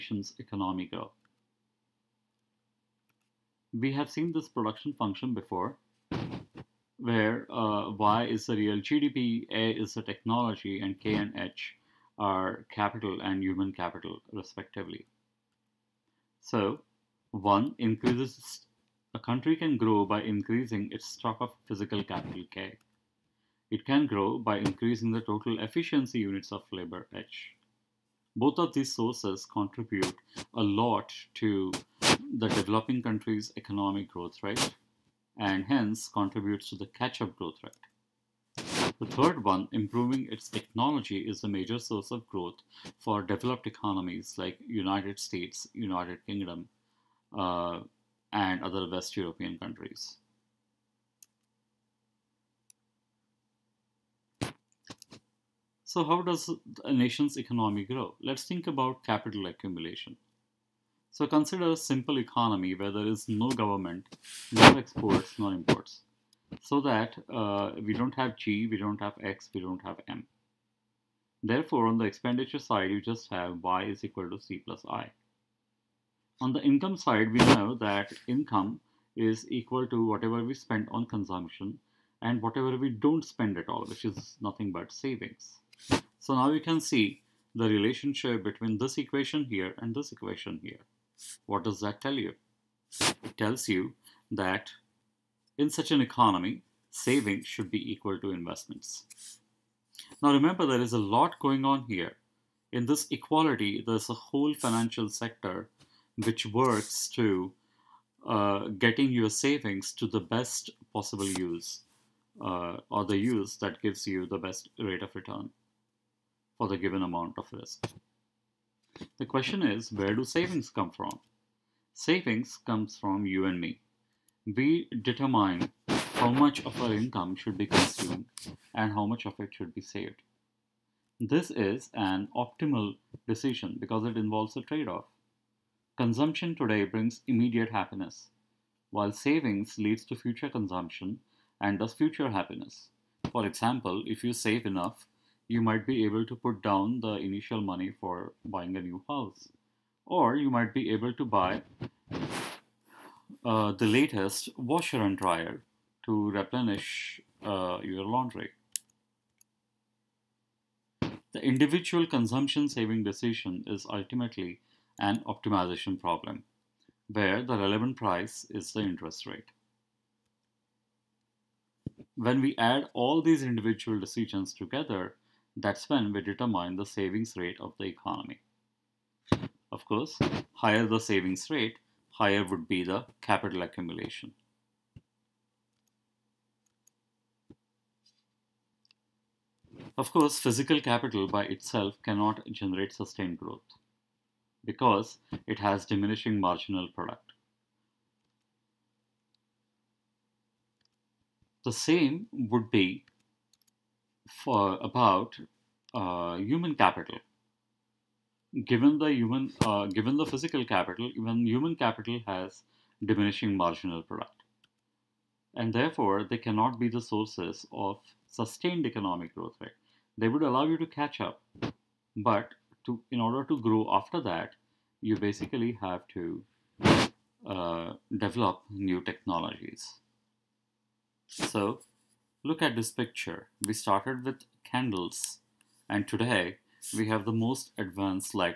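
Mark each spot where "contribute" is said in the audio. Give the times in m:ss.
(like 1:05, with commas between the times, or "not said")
0:29, 0:36.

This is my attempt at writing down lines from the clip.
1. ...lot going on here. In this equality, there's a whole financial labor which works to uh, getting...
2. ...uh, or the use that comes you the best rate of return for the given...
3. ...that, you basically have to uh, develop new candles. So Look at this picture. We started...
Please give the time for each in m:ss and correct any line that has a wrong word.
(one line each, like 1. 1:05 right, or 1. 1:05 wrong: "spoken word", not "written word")
1. 1:41 wrong: "sector", not "labor"
2. 1:52 wrong: "gives", not "comes"
3. 3:44 wrong: "technologies", not "candles".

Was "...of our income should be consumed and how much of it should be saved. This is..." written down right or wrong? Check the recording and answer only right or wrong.
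right.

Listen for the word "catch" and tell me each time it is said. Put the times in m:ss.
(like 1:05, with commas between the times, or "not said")
0:36, 3:40.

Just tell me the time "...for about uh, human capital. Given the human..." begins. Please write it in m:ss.
3:24.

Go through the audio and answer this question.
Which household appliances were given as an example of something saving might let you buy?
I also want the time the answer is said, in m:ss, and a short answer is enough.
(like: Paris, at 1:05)
Washer and dryer, at 2:34.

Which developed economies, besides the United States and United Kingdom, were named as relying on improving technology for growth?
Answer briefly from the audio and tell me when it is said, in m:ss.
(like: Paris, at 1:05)
West European countries, at 0:48.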